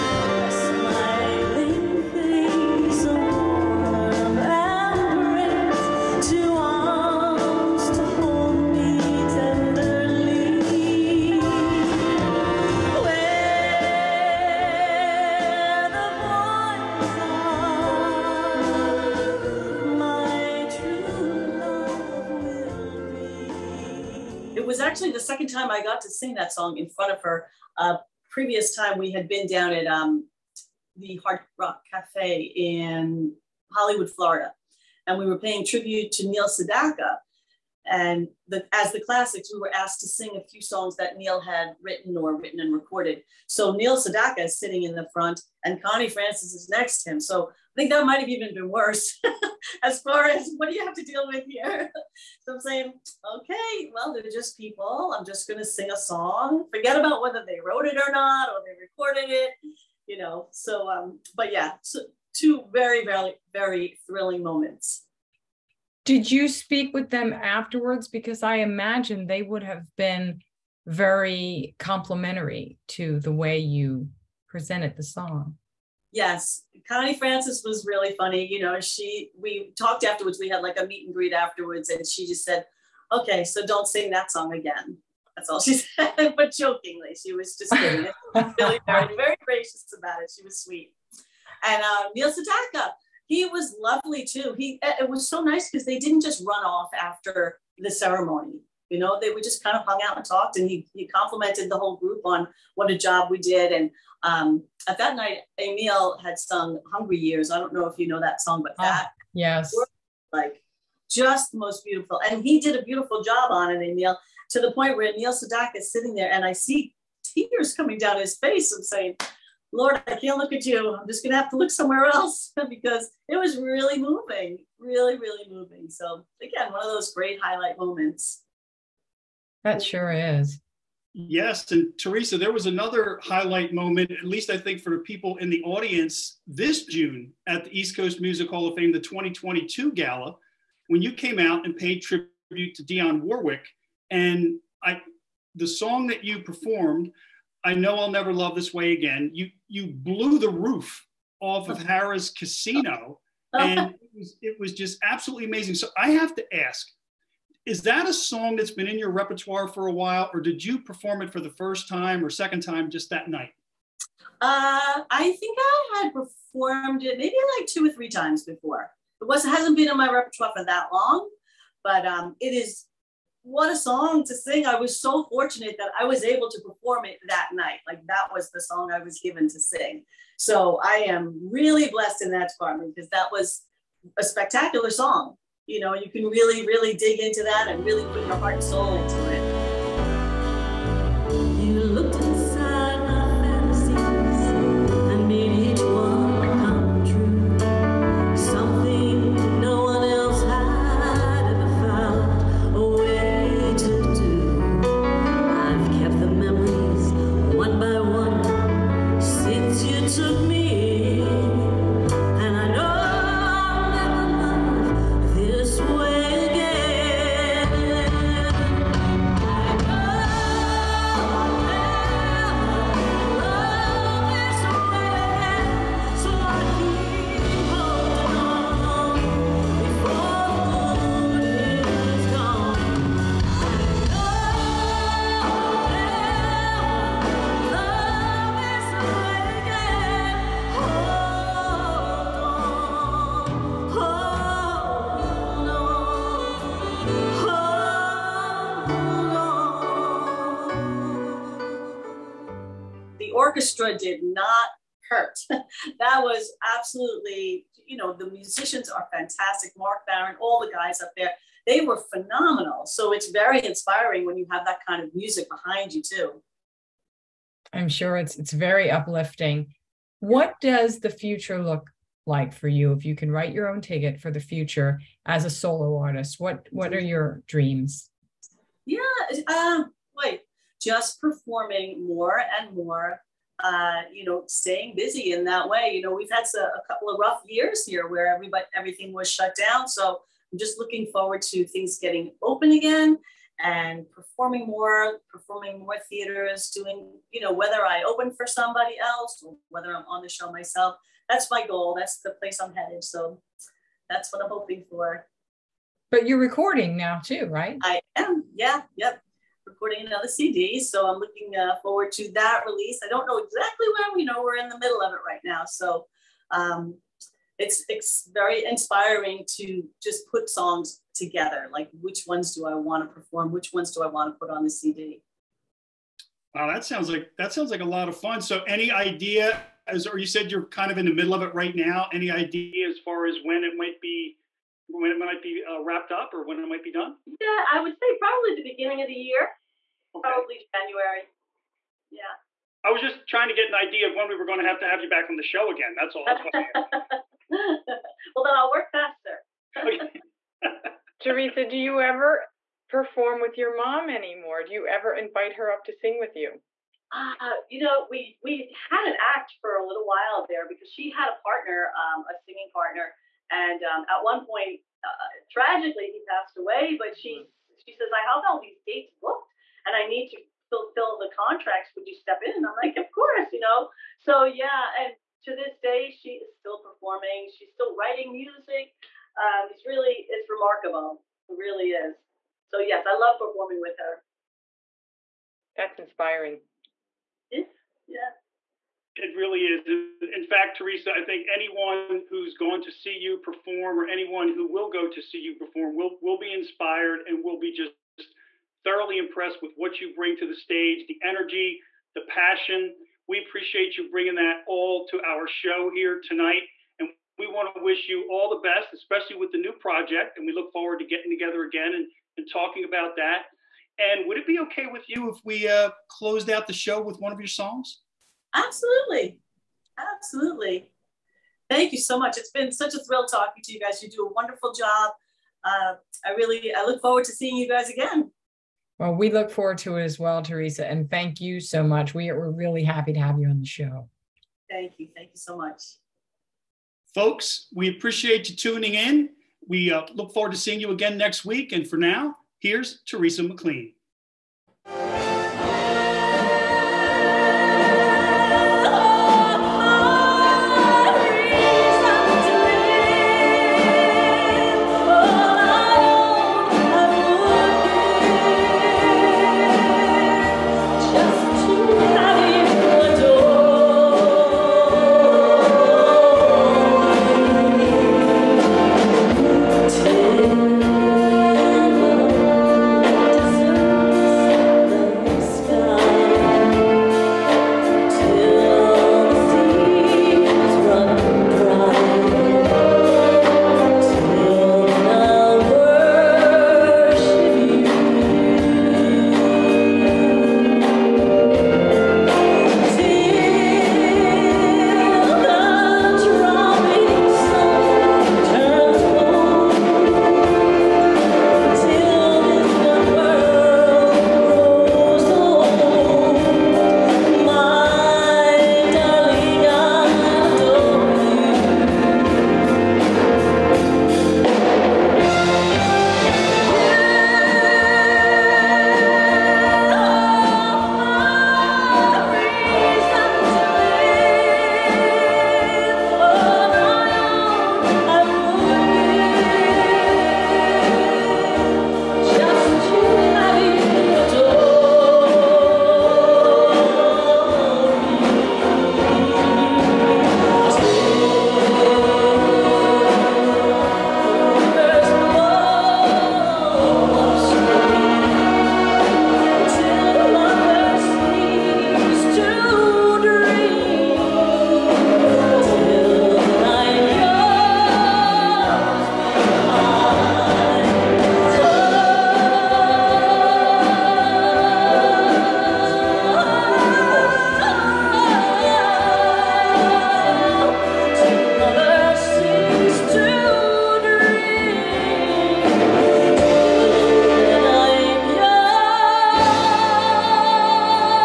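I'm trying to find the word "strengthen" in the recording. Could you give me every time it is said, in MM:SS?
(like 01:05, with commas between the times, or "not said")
not said.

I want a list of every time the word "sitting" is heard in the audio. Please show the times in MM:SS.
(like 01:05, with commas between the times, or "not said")
00:44, 01:55.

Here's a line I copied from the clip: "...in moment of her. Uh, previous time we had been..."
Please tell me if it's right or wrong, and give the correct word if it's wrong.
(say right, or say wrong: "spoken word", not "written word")
wrong: "front", not "moment".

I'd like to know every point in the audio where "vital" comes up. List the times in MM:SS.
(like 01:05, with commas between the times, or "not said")
not said.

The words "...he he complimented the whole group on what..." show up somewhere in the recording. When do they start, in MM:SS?
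01:40.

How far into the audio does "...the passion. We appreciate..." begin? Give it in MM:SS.
06:42.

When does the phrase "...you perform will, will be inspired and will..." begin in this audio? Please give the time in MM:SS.
06:35.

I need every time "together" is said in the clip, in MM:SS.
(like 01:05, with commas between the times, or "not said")
05:21, 06:51.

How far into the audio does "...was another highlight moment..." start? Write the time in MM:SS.
02:12.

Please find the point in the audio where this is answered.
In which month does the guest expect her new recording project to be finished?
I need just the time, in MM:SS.
05:40.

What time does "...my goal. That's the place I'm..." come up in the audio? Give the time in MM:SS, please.
05:01.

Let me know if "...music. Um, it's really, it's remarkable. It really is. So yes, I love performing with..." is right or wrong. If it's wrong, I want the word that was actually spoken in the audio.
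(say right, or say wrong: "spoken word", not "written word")
right.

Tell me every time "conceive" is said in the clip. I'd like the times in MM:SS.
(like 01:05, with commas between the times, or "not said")
not said.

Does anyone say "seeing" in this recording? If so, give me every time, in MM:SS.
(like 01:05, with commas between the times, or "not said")
07:07, 07:20.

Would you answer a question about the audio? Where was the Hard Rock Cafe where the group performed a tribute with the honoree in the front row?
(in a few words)
Hollywood, Florida.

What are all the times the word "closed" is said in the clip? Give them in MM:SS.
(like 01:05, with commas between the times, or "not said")
06:56.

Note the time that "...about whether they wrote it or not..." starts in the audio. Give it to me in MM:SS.
00:56.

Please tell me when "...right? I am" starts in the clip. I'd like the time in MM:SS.
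05:07.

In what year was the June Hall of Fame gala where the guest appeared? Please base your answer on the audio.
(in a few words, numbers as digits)
2022.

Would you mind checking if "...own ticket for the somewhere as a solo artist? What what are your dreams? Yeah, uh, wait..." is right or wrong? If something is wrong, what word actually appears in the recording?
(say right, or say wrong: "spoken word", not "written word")
wrong: "future", not "somewhere".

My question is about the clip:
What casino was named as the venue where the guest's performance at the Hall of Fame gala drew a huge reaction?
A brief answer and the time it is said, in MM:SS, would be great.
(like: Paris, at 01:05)
Harrah's Casino, at 02:31.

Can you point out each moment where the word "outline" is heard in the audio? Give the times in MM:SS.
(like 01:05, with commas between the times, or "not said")
not said.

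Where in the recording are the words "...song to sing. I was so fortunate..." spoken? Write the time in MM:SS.
02:53.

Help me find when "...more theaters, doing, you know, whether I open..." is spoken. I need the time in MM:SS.
04:55.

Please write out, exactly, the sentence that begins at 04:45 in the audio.
You know, we've had a, a couple of rough years here where everybody, everything was shut down.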